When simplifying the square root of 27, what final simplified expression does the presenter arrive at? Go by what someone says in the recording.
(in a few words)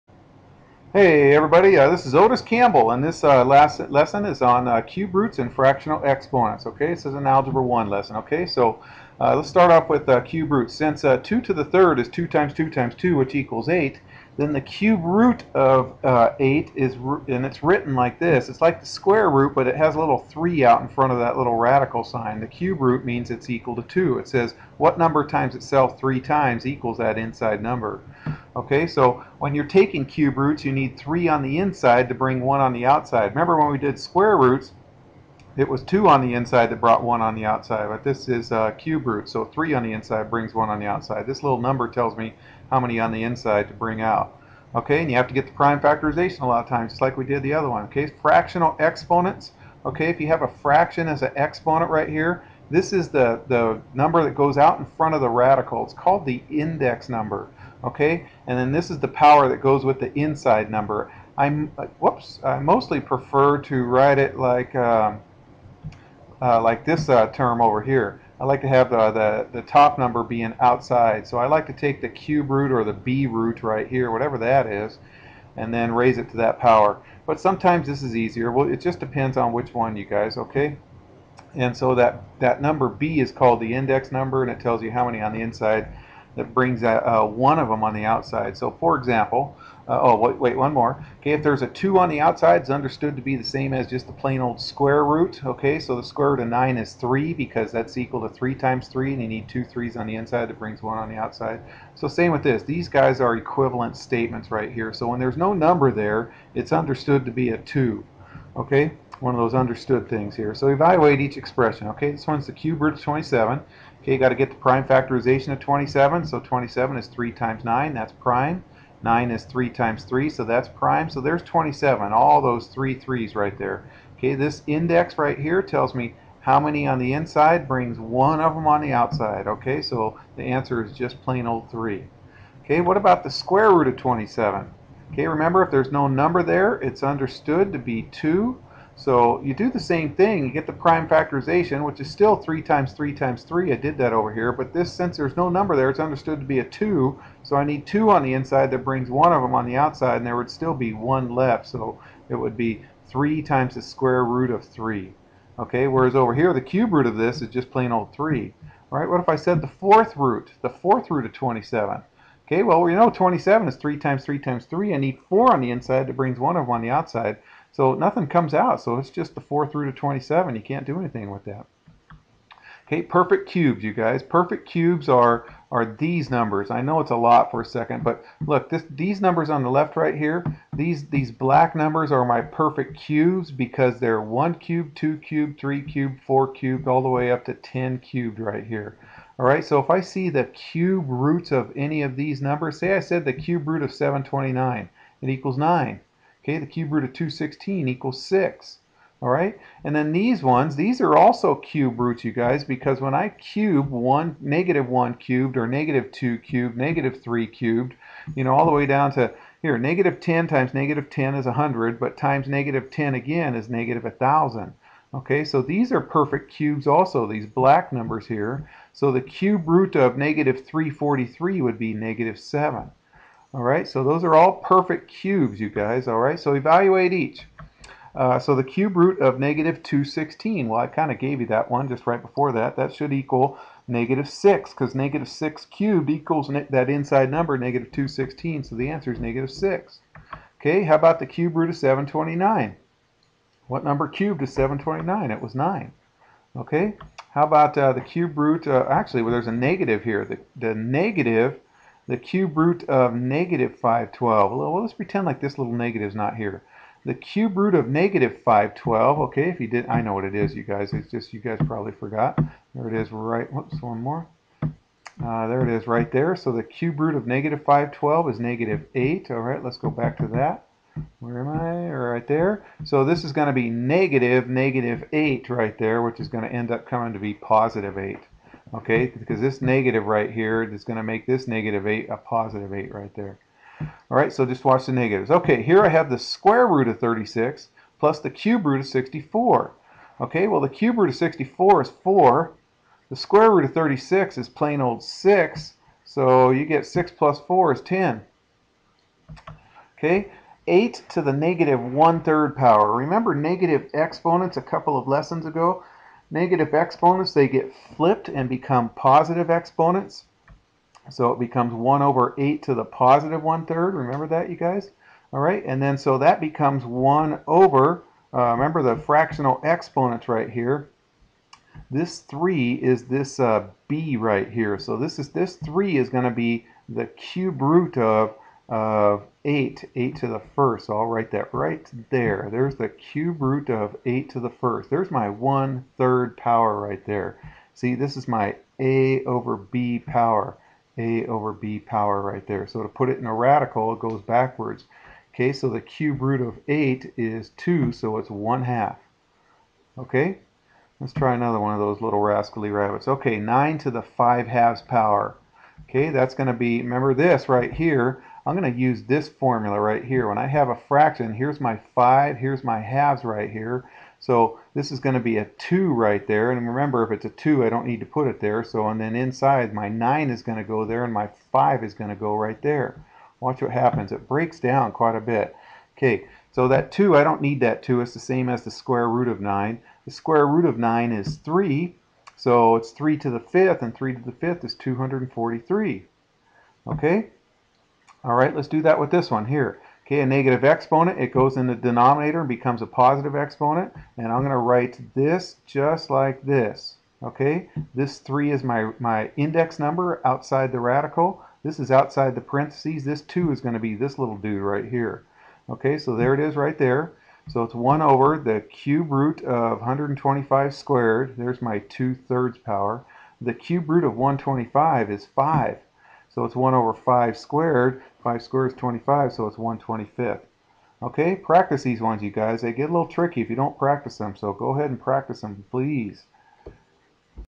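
3 times the square root of 3.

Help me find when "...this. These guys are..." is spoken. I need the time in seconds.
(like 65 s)
102 s.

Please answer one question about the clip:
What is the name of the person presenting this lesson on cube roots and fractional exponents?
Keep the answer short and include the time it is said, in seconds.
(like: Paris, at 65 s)
Otis Campbell, at 2 s.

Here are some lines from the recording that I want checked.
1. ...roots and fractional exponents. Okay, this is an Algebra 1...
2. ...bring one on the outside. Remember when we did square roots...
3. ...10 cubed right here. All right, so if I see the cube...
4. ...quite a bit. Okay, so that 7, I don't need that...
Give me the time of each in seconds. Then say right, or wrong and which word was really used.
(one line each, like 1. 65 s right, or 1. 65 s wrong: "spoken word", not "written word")
1. 5 s right
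2. 32 s right
3. 187 s right
4. 374 s wrong: "2", not "7".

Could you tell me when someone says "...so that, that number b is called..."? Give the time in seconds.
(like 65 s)
81 s.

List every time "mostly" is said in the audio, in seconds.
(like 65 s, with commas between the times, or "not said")
62 s.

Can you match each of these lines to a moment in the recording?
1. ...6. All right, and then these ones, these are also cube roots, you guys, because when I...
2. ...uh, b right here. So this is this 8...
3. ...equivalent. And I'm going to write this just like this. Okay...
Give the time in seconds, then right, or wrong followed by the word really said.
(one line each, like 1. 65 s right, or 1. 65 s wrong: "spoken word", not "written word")
1. 198 s right
2. 323 s wrong: "3", not "8"
3. 393 s wrong: "exponent", not "equivalent".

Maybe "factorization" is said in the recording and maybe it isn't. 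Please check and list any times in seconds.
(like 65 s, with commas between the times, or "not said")
45 s, 114 s, 141 s.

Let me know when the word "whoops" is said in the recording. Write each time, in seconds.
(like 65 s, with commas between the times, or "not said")
61 s, 263 s.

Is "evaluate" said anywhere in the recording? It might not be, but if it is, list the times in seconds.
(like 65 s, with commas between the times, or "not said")
110 s, 226 s.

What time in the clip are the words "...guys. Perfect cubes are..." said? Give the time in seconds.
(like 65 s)
173 s.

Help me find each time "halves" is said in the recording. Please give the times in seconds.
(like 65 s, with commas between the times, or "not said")
354 s, 362 s.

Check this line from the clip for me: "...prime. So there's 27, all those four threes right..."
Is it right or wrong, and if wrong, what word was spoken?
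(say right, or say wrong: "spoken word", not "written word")
wrong: "three", not "four".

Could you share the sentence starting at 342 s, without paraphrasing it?
So to put it in a radical, it goes backwards.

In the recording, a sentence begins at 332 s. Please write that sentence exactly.
There's the cube root of 8 to the first.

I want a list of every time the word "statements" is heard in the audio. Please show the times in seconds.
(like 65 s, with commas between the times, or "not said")
103 s.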